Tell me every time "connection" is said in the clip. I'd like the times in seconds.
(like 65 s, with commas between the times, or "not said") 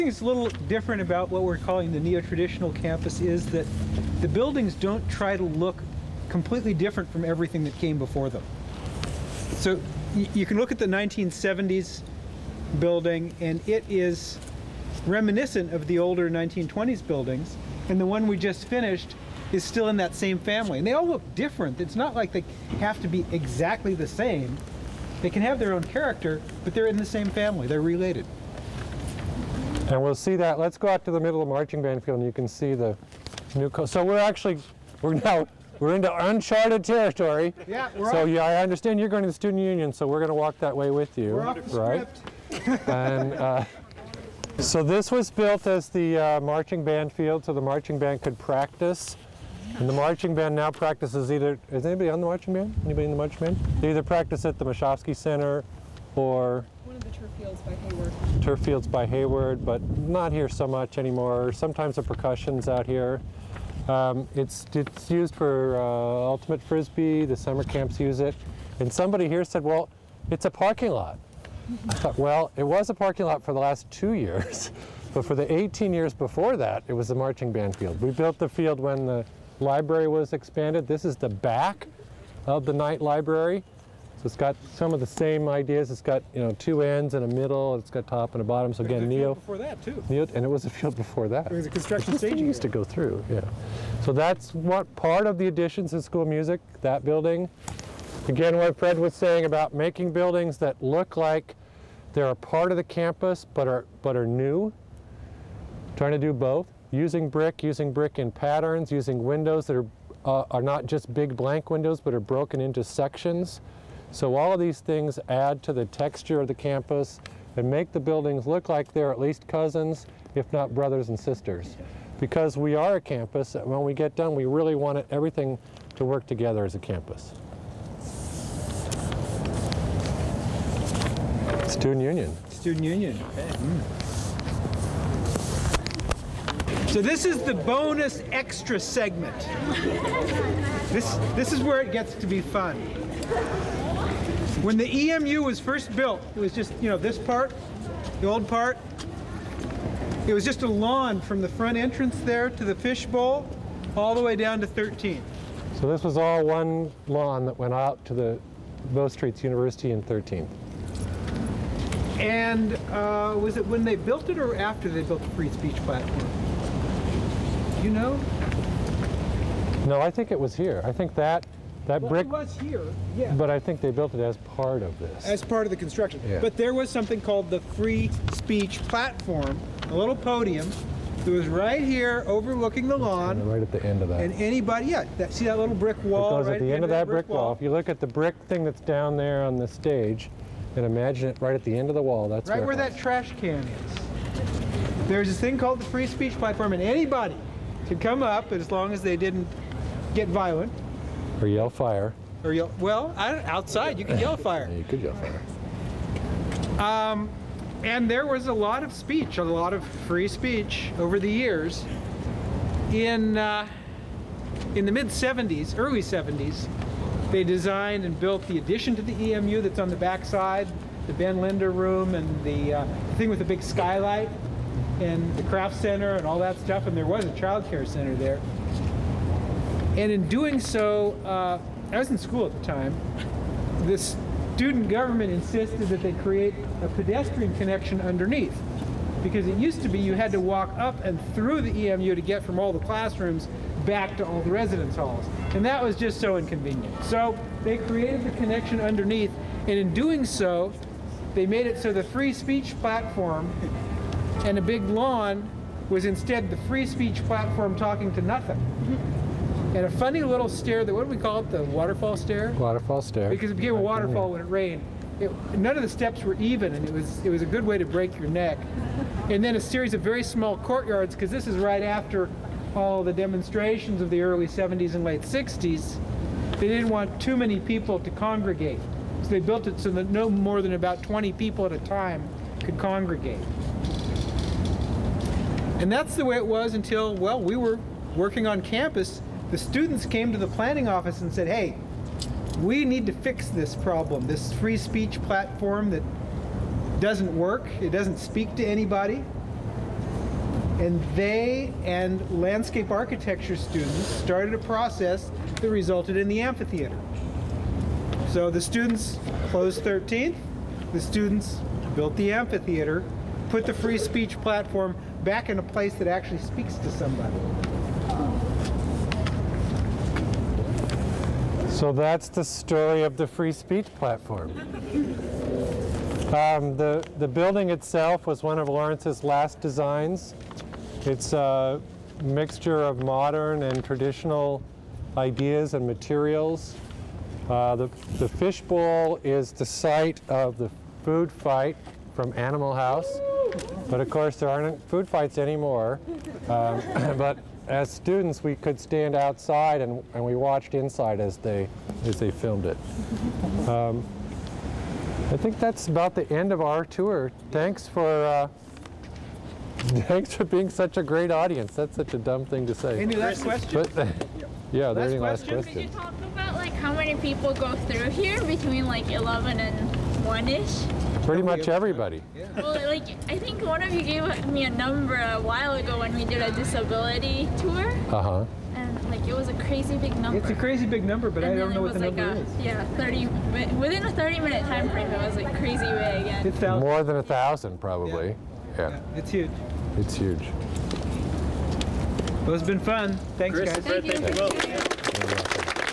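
237 s, 248 s.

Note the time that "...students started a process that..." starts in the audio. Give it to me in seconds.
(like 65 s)
303 s.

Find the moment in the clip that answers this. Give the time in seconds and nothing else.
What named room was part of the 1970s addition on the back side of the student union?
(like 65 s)
221 s.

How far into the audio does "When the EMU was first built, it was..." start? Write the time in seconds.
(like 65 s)
144 s.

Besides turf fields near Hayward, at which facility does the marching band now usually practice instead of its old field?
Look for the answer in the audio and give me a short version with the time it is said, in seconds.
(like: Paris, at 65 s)
Moshofsky Center, at 54 s.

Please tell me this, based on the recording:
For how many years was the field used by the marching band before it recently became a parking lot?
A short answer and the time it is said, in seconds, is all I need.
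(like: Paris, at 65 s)
18, at 75 s.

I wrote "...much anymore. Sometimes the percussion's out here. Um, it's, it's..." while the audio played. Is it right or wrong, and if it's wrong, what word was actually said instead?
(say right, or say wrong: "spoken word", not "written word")
right.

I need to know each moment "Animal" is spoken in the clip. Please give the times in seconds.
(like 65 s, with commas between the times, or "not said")
342 s.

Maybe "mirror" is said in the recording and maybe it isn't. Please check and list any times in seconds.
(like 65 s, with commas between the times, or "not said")
not said.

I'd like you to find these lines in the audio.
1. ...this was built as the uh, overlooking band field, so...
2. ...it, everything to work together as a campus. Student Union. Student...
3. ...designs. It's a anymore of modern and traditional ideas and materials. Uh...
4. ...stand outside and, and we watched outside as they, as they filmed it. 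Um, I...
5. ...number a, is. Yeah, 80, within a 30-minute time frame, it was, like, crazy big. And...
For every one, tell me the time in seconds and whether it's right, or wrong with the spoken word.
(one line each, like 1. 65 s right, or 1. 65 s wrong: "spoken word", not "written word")
1. 44 s wrong: "marching", not "overlooking"
2. 124 s right
3. 329 s wrong: "mixture", not "anymore"
4. 348 s wrong: "inside", not "outside"
5. 382 s wrong: "30", not "80".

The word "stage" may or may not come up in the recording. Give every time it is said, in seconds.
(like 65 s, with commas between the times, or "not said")
92 s, 189 s.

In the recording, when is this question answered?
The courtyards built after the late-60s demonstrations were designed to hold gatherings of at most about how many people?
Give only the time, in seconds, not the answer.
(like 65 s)
281 s.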